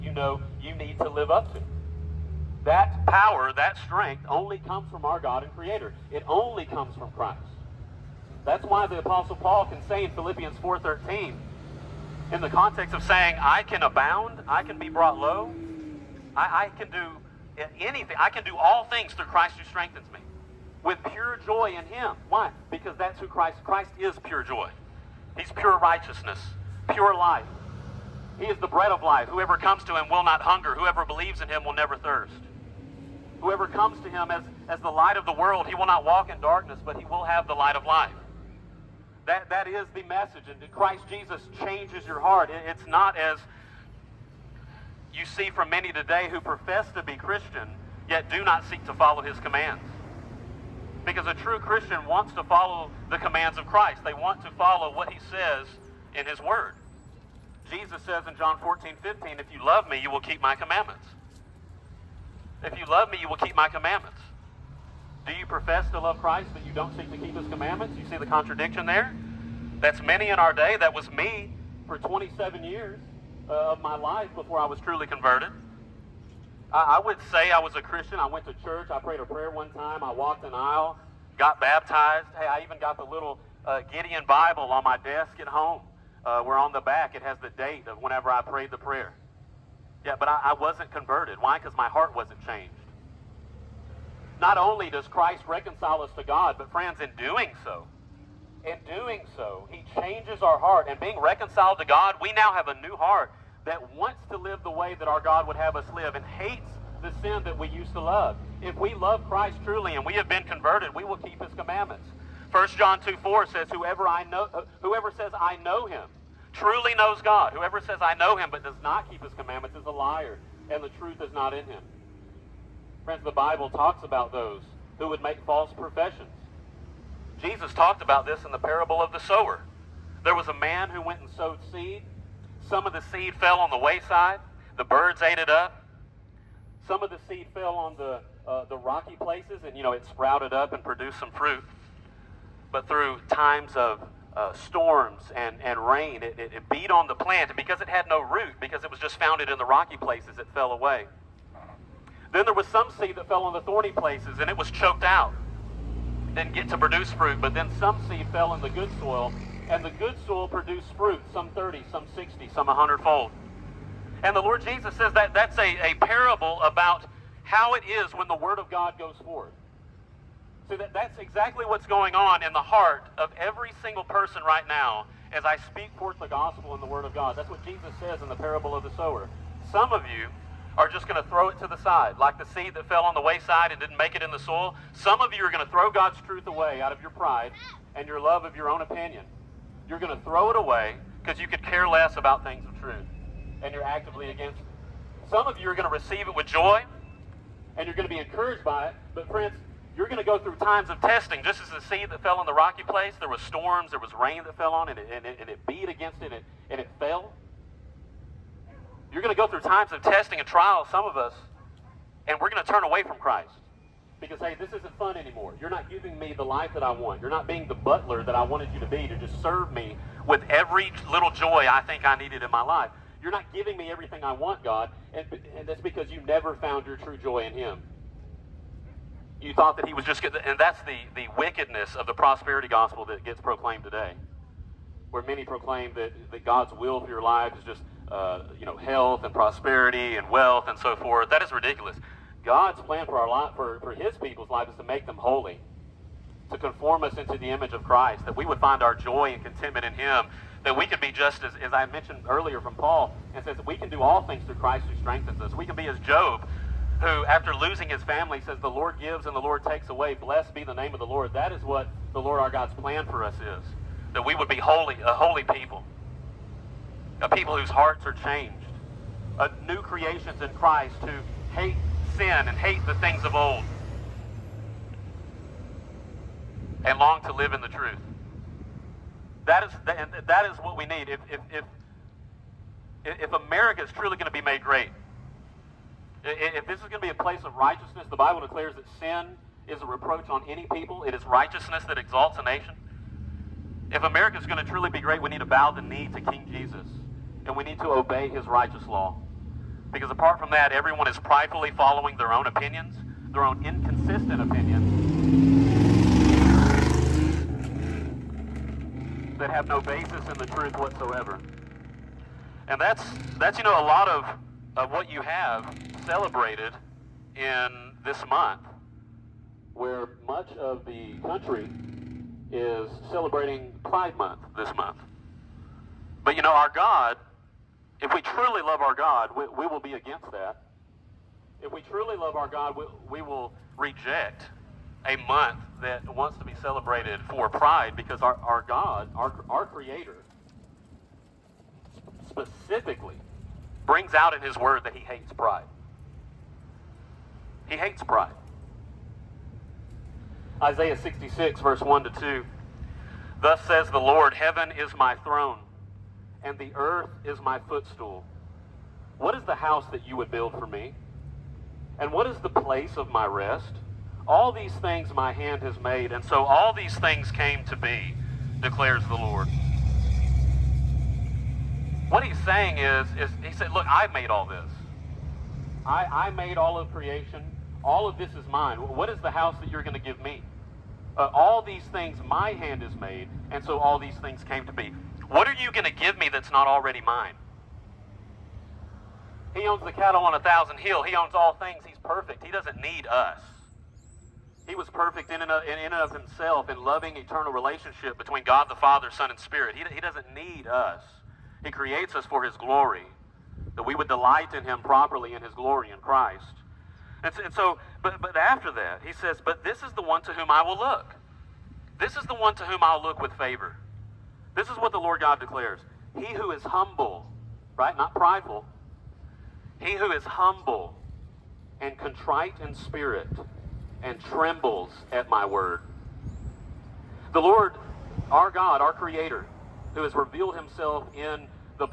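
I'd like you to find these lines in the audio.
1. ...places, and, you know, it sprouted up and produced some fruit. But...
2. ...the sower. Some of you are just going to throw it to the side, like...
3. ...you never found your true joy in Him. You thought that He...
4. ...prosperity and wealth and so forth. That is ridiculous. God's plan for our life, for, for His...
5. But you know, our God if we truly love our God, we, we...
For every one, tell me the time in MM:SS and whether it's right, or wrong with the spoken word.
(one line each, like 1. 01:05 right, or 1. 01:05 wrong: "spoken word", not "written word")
1. 02:19 right
2. 02:58 right
3. 03:46 right
4. 03:59 right
5. 05:26 right.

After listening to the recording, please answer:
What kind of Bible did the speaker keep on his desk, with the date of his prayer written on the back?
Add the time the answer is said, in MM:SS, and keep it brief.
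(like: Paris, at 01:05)
Gideon Bible, at 01:23.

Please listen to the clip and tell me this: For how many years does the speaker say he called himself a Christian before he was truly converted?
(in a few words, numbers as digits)
27.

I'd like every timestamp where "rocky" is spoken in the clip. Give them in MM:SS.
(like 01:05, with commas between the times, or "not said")
02:18, 02:29, 03:22.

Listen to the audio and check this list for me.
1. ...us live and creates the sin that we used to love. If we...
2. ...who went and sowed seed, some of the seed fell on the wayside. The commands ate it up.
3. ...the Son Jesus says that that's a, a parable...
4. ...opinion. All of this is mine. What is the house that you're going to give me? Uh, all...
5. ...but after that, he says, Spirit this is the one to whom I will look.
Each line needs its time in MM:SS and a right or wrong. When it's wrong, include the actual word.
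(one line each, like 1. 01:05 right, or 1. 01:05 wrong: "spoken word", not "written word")
1. 01:45 wrong: "hates", not "creates"
2. 02:10 wrong: "birds", not "commands"
3. 02:44 wrong: "Lord", not "Son"
4. 06:16 wrong: "creation", not "opinion"
5. 06:48 wrong: "But", not "Spirit".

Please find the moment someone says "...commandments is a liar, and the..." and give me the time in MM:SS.
01:59.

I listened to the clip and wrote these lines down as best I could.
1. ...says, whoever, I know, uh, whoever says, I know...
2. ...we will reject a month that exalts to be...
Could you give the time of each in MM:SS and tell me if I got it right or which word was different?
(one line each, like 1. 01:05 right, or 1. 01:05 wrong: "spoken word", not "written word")
1. 01:53 right
2. 05:33 wrong: "wants", not "exalts".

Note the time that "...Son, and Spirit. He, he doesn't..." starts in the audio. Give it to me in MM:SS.
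06:39.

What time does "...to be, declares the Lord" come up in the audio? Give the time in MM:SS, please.
06:07.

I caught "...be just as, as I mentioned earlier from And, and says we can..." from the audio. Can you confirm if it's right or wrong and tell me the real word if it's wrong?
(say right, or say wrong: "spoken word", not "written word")
wrong: "Paul", not "And".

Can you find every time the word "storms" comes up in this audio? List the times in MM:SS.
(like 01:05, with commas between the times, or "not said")
02:24, 03:23.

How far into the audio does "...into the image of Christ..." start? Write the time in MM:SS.
04:07.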